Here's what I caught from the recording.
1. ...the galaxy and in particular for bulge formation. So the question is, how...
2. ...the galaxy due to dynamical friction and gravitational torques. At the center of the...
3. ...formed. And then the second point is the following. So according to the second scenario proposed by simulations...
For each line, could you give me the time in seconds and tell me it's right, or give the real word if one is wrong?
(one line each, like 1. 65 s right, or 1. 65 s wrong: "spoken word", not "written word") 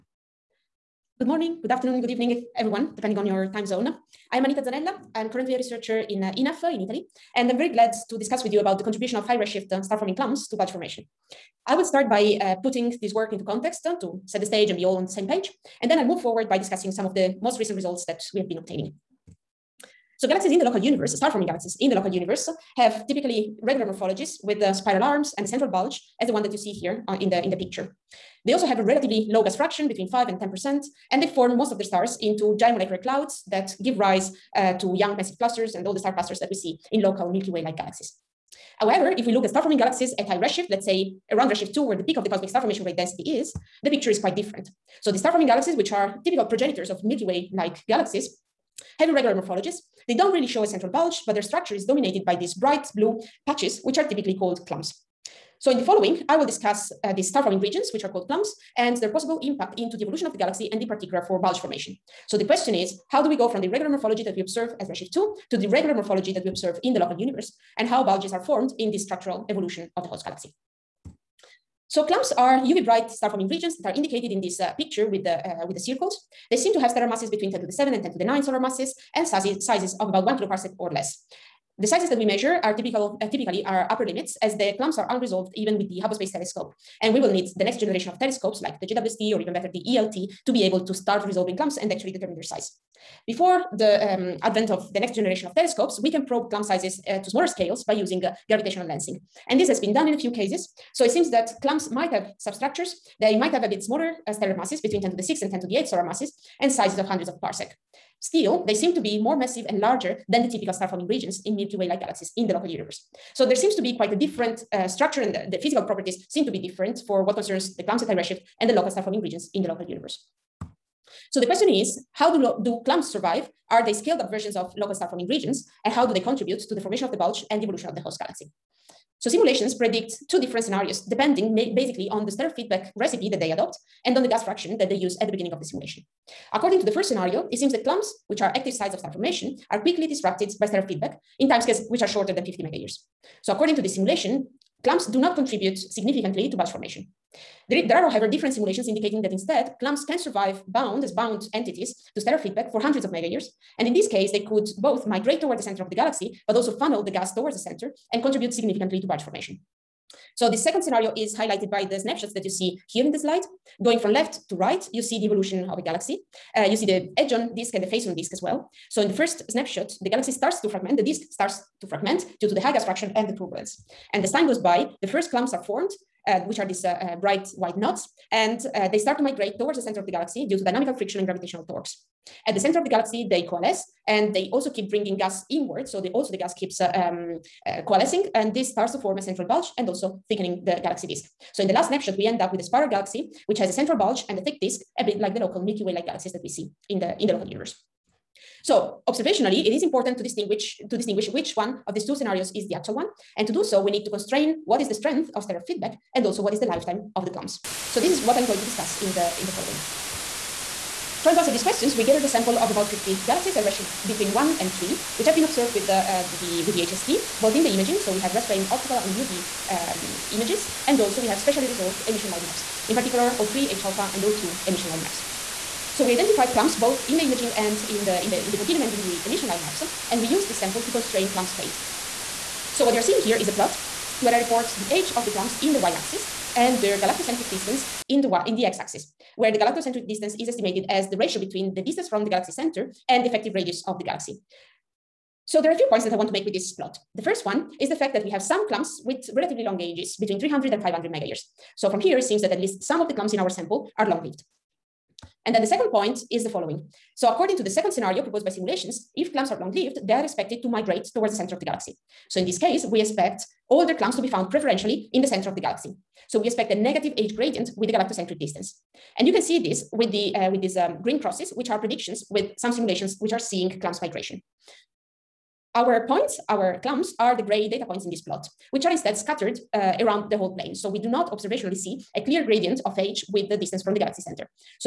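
1. 60 s right
2. 180 s right
3. 254 s wrong: "lived", not "formed".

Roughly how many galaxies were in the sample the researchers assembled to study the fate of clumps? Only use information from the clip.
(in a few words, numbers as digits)
about 50.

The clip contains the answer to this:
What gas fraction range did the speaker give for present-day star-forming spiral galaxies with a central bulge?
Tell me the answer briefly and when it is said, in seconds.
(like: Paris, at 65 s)
5 to 10 percent, at 29 s.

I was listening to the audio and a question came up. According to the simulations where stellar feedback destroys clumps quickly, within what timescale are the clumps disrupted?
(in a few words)
shorter than 50 megayears.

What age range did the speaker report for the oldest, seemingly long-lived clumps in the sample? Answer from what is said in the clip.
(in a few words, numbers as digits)
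300 to 500 megayears.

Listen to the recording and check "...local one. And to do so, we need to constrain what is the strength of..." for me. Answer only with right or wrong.
wrong.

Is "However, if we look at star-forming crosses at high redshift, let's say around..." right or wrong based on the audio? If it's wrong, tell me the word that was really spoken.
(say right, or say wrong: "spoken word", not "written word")
wrong: "galaxies", not "crosses".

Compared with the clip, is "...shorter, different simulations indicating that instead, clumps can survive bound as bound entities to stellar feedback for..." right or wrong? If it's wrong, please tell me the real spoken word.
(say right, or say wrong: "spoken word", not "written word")
wrong: "however", not "shorter".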